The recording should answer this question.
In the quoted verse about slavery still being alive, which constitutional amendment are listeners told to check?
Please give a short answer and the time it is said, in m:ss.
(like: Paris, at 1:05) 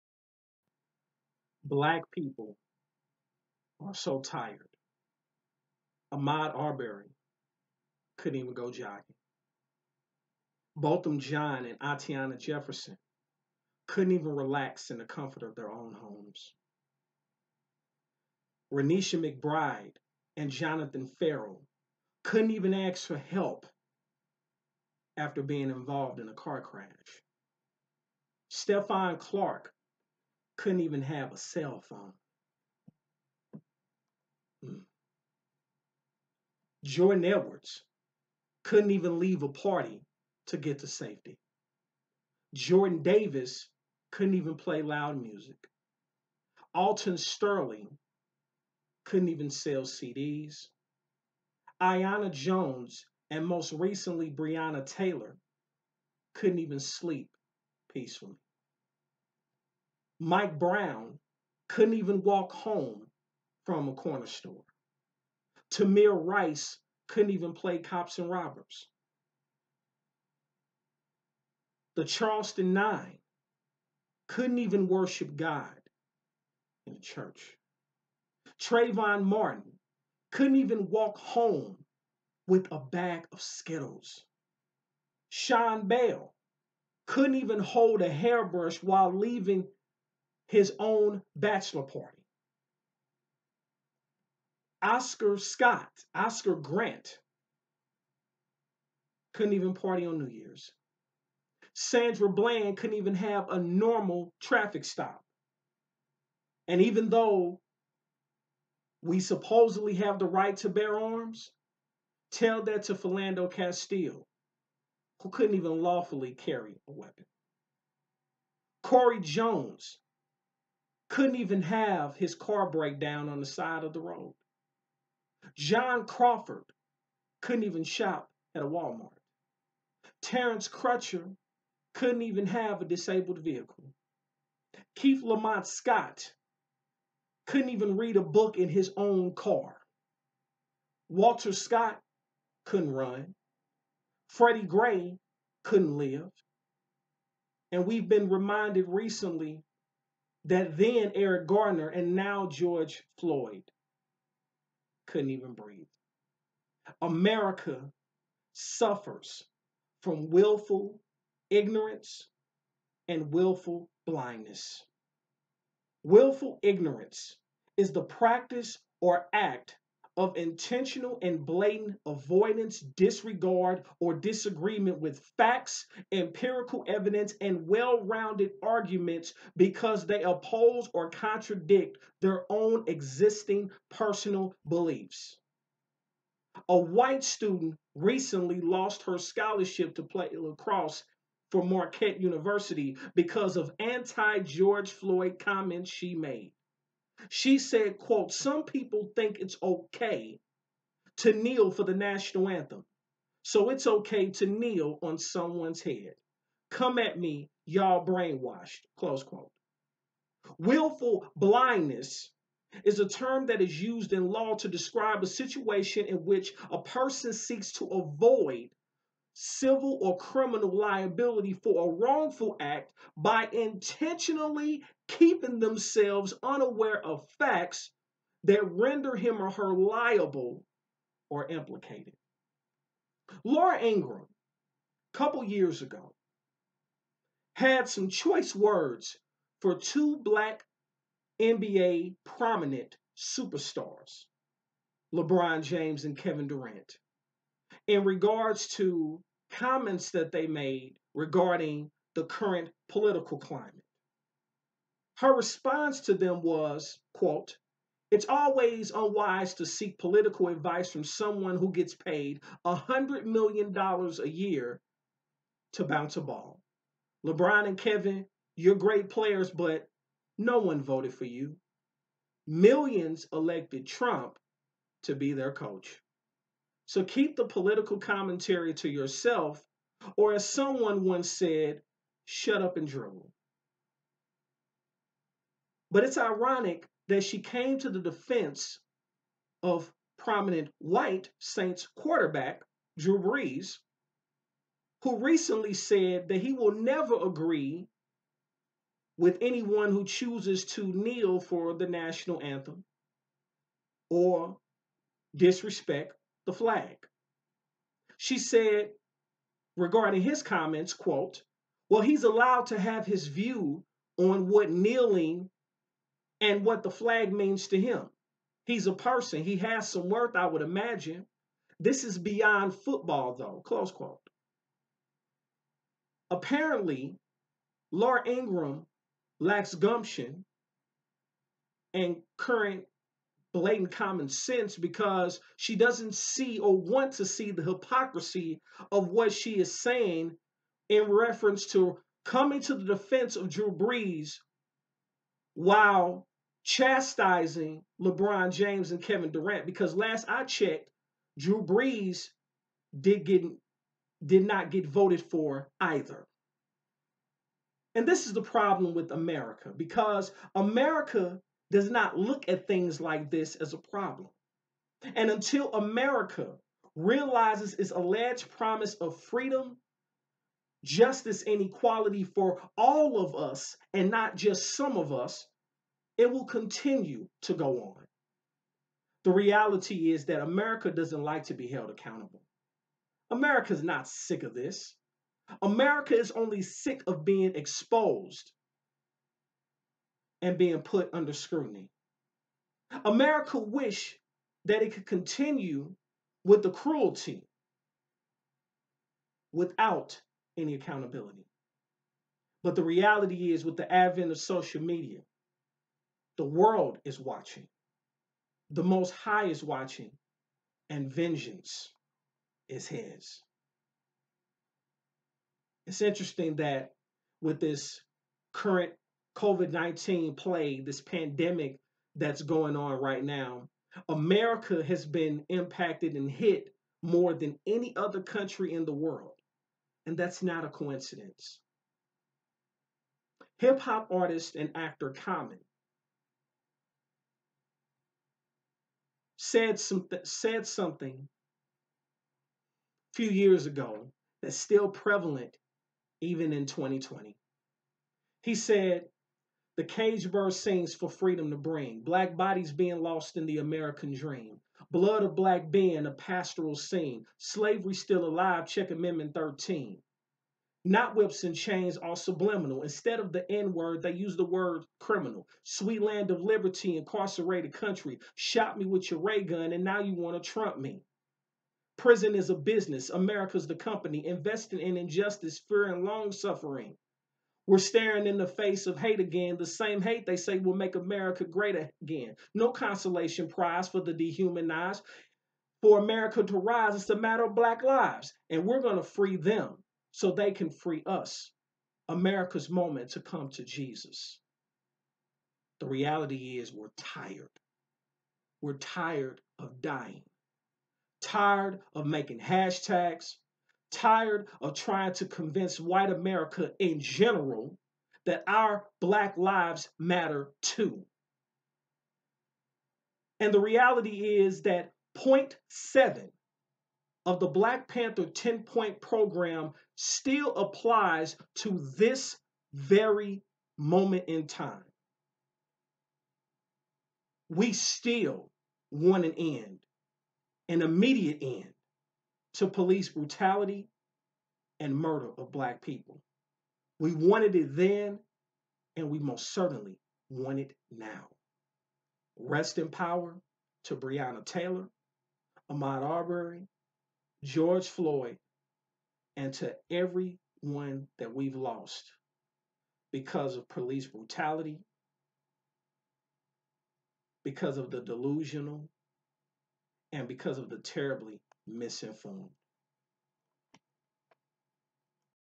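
Amendment 13, at 7:38.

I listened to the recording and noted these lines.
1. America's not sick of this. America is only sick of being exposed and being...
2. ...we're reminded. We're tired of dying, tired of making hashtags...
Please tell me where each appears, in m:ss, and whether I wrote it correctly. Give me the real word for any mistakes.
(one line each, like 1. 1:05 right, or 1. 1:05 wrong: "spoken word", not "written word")
1. 6:23 right
2. 8:16 wrong: "tired", not "reminded".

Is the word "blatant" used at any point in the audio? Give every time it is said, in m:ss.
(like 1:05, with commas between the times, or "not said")
2:51, 5:33.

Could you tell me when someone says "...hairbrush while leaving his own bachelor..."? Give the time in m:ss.
1:28.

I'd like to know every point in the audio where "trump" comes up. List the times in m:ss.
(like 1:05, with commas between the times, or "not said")
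4:33, 7:50.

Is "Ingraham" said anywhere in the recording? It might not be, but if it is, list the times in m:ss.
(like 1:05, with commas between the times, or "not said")
3:53, 5:28.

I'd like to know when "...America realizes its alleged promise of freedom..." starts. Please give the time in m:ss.
6:05.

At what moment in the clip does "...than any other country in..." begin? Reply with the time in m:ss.
7:07.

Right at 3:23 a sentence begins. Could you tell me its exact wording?
So it's okay to kneel on someone's head.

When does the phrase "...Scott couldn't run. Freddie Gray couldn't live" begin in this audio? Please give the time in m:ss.
2:21.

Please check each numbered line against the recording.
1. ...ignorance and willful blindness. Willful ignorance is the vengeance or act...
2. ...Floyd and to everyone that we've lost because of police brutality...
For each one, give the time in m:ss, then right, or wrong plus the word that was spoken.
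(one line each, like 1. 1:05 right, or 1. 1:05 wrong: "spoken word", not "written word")
1. 2:41 wrong: "practice", not "vengeance"
2. 9:07 right.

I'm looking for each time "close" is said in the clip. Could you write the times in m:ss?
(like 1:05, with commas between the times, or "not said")
3:28, 5:23.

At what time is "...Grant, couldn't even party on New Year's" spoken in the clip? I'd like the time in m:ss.
1:36.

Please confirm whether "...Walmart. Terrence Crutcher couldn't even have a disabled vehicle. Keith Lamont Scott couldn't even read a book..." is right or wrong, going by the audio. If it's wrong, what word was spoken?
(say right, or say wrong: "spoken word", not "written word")
right.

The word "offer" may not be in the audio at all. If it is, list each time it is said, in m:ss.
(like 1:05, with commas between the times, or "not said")
not said.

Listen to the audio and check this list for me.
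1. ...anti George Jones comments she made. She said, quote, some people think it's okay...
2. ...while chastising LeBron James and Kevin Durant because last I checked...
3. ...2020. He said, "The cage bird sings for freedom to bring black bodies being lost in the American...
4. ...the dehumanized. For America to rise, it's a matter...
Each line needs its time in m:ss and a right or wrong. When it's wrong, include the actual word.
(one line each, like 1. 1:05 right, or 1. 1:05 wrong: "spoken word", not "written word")
1. 3:13 wrong: "Floyd", not "Jones"
2. 5:45 right
3. 7:26 right
4. 8:04 right.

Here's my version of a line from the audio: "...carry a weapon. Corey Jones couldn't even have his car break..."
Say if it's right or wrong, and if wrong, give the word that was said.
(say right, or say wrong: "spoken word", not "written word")
right.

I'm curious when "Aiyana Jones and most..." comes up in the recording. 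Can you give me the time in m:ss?
0:51.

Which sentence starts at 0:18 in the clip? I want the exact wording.
Renisha McBride and Jonathan Ferrell couldn't even ask for help after being involved in a car crash.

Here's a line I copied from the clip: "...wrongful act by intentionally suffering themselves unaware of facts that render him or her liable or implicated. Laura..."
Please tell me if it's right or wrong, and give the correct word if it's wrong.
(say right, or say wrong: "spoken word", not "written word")
wrong: "keeping", not "suffering".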